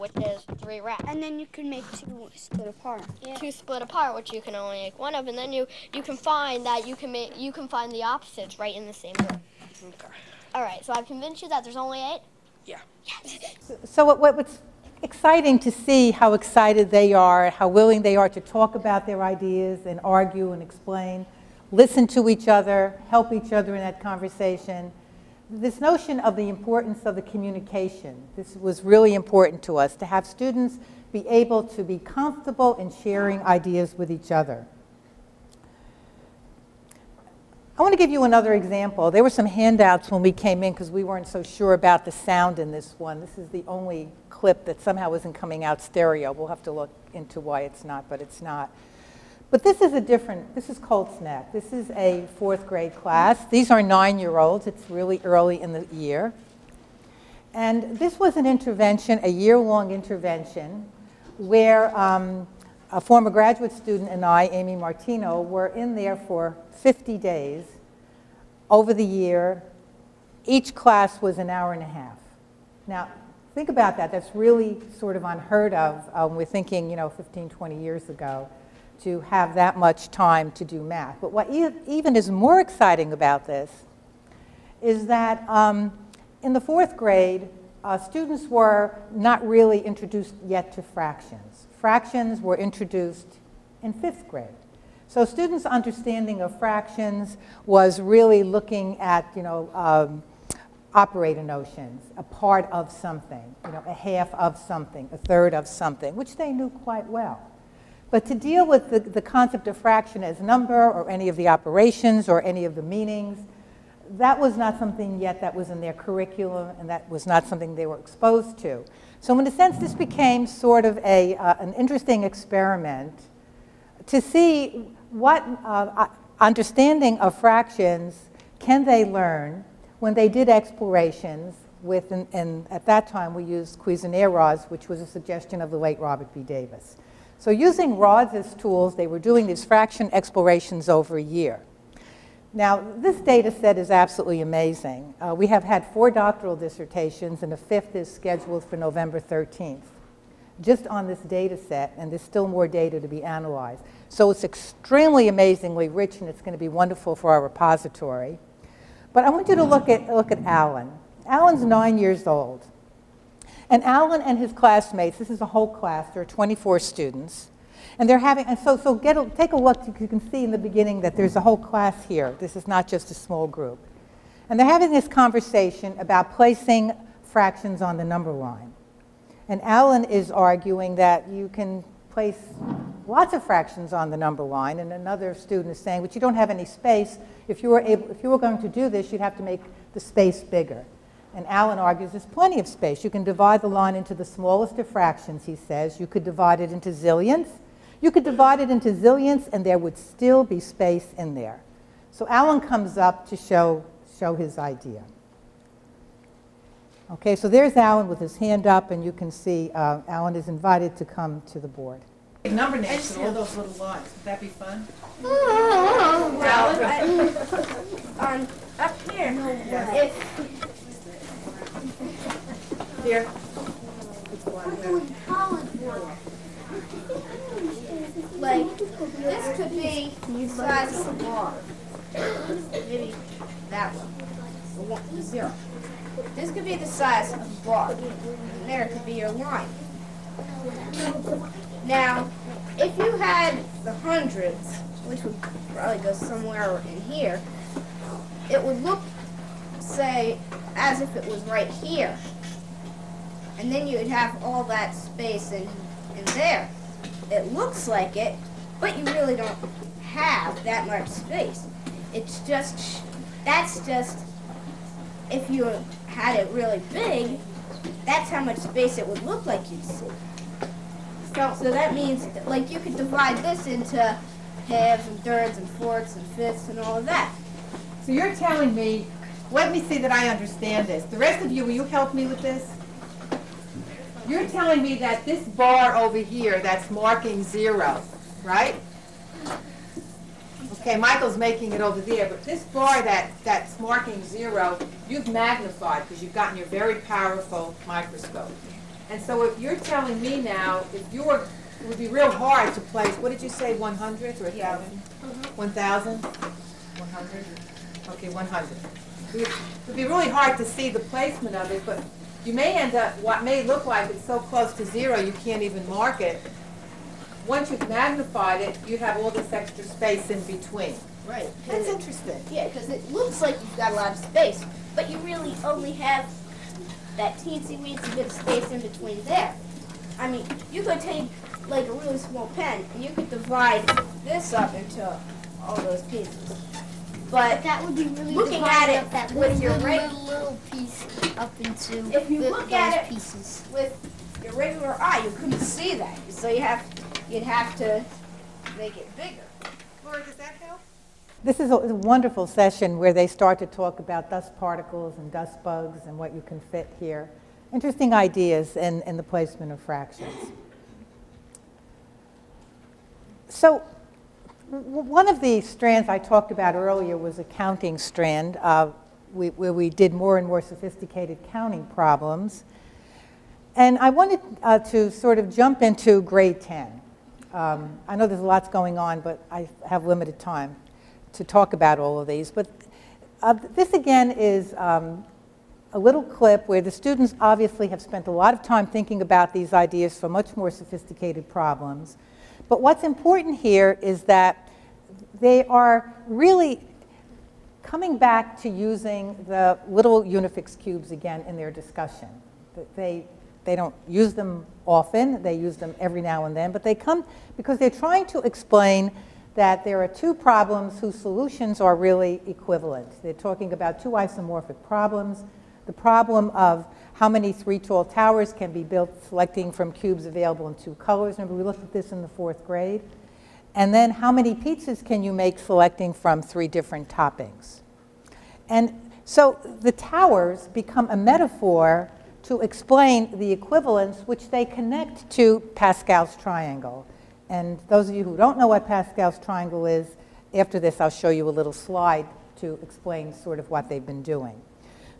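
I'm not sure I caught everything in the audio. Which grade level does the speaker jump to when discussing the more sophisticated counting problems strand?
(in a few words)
Grade 10.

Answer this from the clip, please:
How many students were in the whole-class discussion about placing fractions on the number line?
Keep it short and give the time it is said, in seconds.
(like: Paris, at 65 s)
24, at 166 s.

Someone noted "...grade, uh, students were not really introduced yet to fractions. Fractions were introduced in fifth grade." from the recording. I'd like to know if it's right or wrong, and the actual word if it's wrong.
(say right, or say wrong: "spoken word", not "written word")
right.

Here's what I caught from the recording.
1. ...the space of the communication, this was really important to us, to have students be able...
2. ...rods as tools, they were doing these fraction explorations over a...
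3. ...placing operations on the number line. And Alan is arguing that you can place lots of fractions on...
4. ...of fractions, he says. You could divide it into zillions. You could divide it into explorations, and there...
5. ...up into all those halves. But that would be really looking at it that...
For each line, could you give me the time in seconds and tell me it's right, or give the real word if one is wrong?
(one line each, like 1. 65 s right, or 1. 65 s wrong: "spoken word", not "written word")
1. 26 s wrong: "importance", not "space"
2. 137 s right
3. 176 s wrong: "fractions", not "operations"
4. 194 s wrong: "zillions", not "explorations"
5. 334 s wrong: "pieces", not "halves".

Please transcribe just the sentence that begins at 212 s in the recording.
Number names and all those little lots.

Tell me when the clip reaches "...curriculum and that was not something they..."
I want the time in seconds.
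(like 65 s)
115 s.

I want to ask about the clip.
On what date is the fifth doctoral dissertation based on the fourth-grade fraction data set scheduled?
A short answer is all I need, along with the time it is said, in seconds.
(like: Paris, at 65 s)
November 13th, at 148 s.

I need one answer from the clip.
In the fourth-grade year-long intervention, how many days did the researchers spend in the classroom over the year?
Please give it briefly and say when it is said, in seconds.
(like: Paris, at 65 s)
50, at 66 s.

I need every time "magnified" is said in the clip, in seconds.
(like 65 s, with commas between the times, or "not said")
295 s, 317 s.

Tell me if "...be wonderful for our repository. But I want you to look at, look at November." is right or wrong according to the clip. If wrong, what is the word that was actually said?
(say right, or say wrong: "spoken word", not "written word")
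wrong: "Alan", not "November".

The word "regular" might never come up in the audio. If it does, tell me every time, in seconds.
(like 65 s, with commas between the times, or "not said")
339 s, 344 s.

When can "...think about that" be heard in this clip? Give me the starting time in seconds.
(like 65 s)
73 s.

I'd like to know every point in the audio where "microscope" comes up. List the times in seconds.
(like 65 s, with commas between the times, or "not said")
297 s.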